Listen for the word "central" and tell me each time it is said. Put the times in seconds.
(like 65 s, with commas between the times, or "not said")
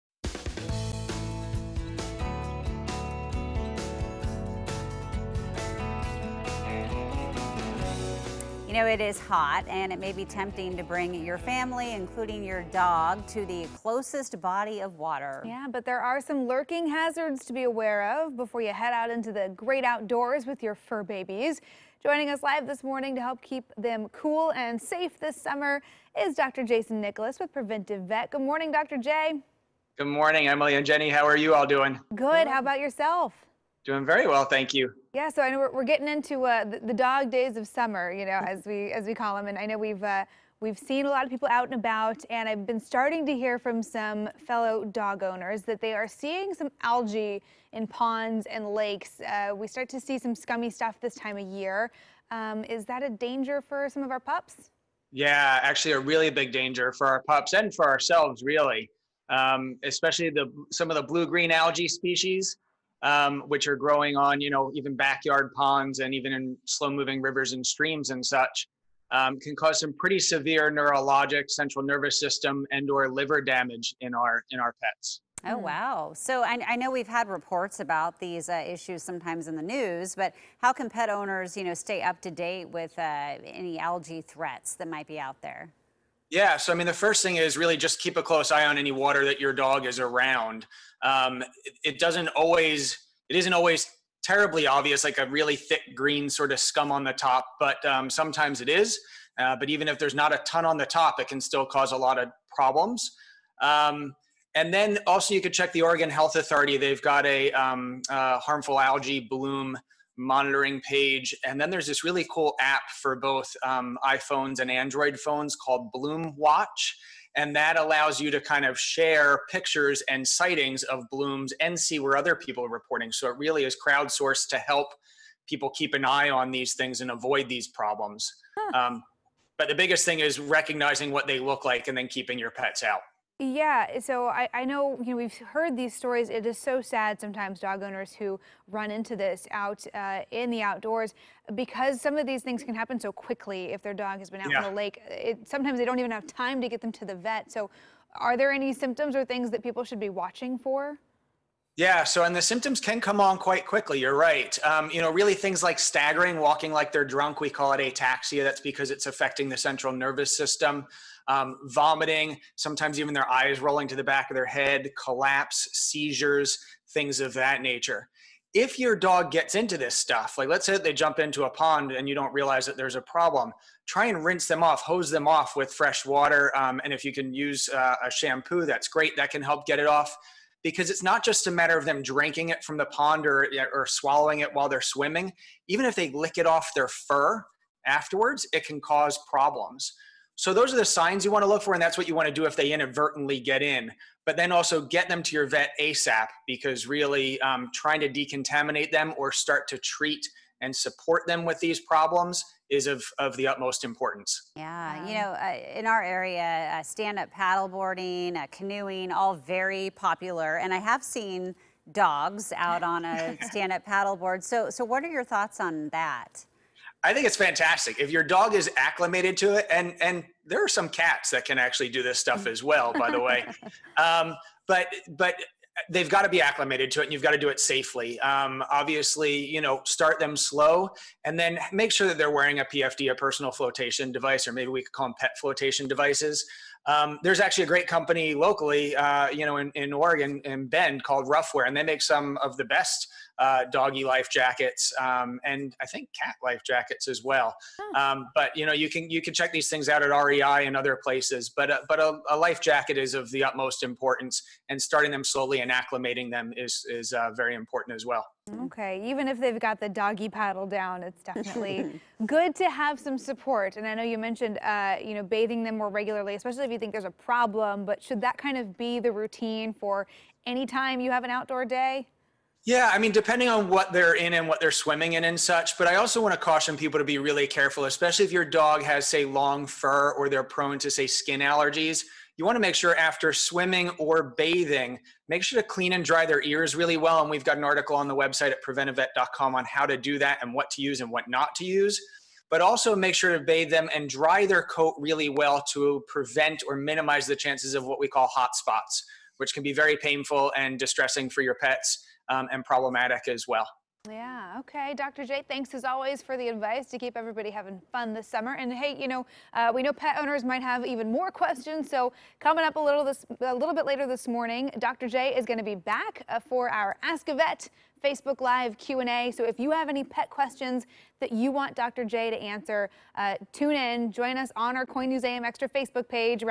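71 s, 159 s.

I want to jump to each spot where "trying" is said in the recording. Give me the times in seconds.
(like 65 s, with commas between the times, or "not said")
197 s.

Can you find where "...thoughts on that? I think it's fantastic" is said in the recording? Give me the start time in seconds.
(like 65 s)
215 s.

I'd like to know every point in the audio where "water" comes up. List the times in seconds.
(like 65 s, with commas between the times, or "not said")
14 s, 88 s, 176 s.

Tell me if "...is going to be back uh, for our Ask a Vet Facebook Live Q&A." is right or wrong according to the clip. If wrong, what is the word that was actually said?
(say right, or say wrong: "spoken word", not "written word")
right.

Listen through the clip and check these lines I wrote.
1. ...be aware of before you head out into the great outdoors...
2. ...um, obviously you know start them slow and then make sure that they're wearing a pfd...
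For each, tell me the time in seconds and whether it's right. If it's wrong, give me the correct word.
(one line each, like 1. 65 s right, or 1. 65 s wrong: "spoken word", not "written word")
1. 17 s right
2. 228 s right.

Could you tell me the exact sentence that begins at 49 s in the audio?
Uh, we start to see some scummy stuff this time of year.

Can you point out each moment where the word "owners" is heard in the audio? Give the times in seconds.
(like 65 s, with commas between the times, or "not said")
45 s, 81 s, 137 s, 310 s.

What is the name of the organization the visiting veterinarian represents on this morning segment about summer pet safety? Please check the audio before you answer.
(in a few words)
Preventive Vet.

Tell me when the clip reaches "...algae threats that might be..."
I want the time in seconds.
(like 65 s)
83 s.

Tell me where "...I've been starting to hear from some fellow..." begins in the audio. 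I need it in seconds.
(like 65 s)
42 s.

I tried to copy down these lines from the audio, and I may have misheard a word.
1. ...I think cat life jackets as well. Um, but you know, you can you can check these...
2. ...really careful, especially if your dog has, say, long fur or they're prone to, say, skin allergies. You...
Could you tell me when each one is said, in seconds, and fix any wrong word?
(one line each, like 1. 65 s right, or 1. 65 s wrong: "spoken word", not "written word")
1. 245 s right
2. 277 s right.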